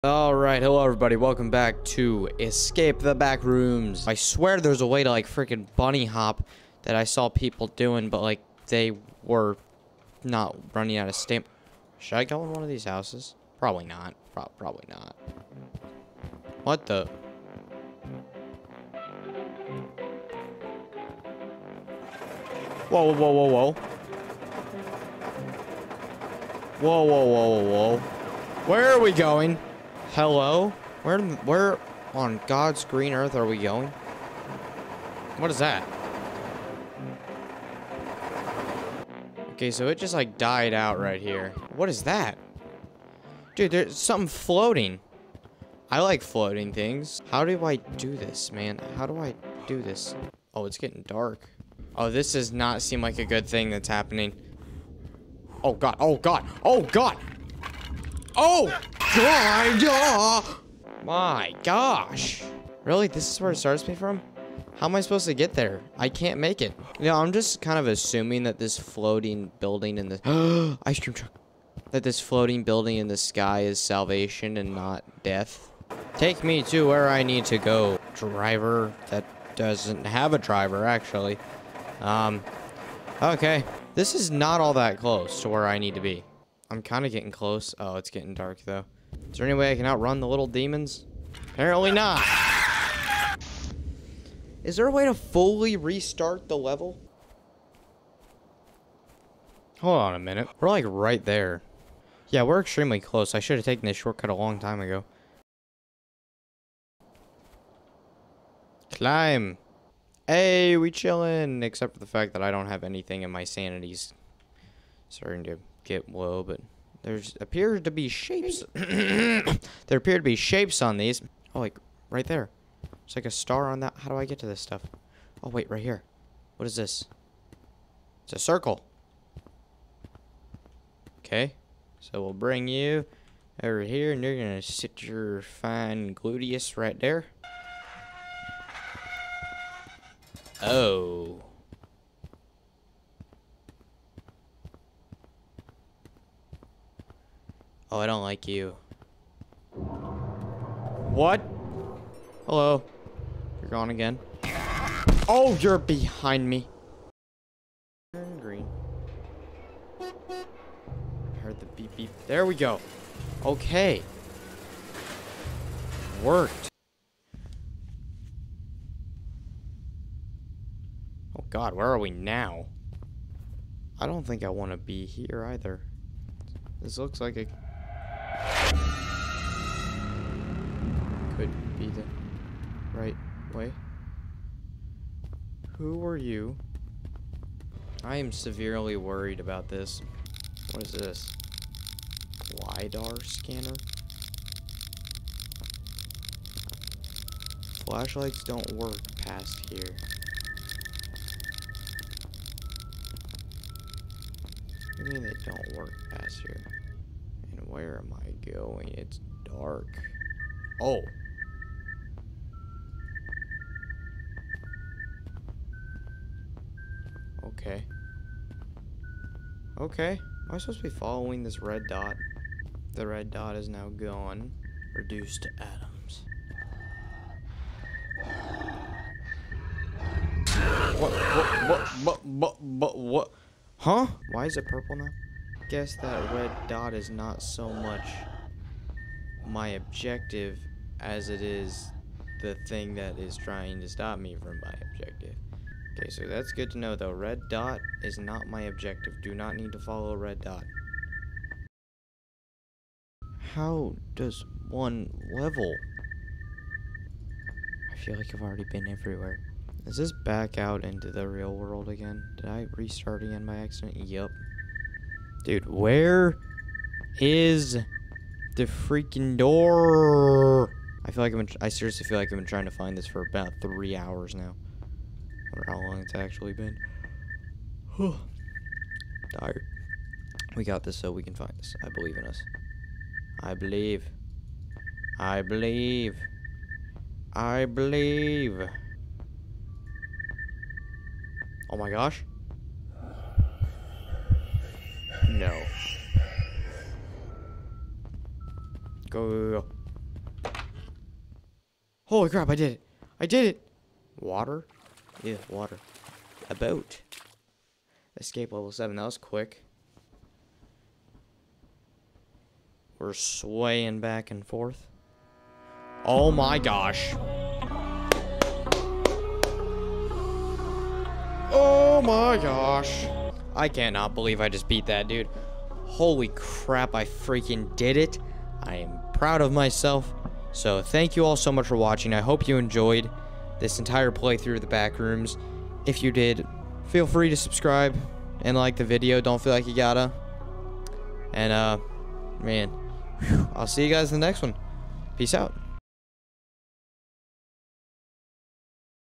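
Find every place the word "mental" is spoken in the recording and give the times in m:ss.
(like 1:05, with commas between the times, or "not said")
not said.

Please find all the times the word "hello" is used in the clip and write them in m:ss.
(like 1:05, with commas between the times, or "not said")
0:00, 0:30, 2:32.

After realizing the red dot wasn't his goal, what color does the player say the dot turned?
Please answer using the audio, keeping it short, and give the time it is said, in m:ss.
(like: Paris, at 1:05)
Purple, at 3:54.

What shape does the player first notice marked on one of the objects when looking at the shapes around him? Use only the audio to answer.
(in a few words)
Star.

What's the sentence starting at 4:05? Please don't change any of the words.
Okay, so that's good to know though.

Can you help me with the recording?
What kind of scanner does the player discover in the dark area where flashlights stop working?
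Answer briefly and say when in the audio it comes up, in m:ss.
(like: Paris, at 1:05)
LiDAR scanner, at 3:12.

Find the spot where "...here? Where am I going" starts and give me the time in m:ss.
3:26.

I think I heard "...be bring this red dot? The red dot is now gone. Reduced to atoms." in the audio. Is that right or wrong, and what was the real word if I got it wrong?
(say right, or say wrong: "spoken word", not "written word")
wrong: "following", not "bring".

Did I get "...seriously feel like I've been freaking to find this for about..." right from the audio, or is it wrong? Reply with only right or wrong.
wrong.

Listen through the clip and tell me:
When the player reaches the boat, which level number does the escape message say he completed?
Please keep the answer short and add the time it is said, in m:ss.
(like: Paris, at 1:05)
7, at 5:08.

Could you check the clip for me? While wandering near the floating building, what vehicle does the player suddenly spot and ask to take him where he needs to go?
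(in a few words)
Ice cream truck.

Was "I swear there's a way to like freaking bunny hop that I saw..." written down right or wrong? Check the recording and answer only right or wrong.
right.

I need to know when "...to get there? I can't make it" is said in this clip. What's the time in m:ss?
1:05.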